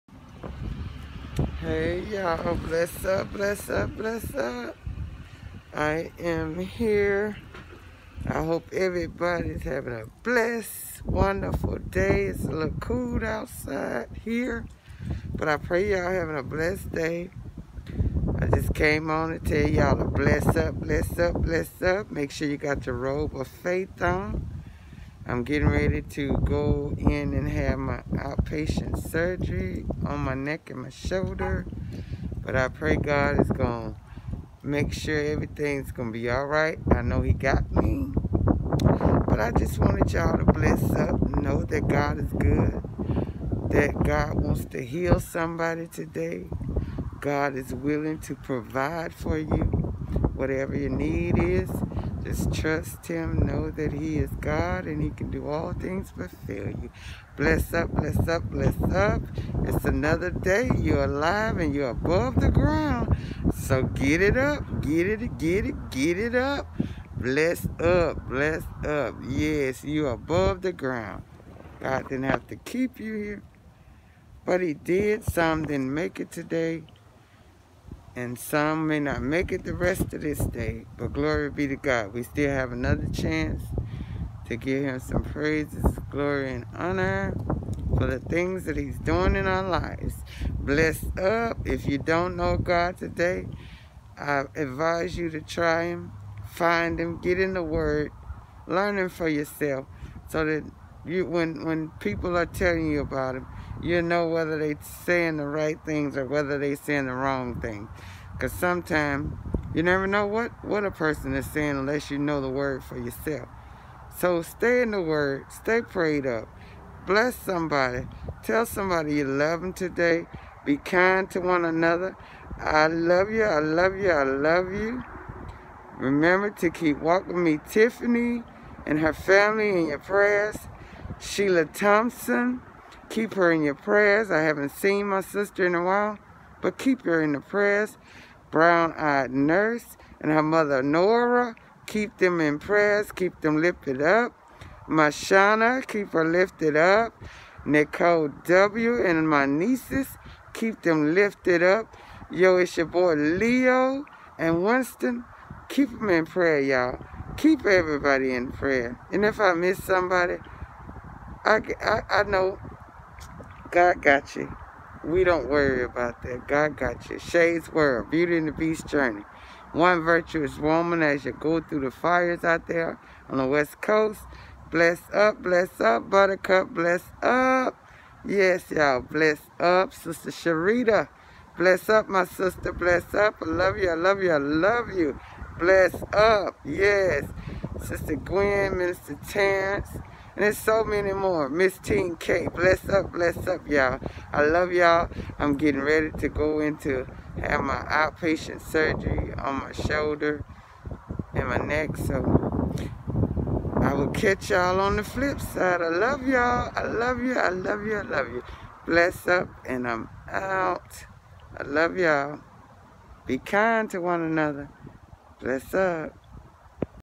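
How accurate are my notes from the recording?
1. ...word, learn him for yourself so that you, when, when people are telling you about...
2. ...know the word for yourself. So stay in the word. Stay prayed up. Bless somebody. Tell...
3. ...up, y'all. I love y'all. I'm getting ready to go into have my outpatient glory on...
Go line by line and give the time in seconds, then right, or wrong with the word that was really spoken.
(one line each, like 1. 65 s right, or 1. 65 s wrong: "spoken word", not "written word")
1. 97 s right
2. 112 s right
3. 193 s wrong: "surgery", not "glory".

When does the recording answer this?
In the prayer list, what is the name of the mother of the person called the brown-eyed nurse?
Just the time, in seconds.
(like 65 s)
140 s.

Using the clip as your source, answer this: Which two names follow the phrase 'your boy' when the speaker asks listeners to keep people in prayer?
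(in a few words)
Leo and Winston.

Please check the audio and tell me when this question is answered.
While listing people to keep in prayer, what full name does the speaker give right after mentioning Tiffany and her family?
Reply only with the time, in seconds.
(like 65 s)
131 s.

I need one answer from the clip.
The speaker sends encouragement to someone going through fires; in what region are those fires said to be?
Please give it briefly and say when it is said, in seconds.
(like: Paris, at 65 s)
West Coast, at 173 s.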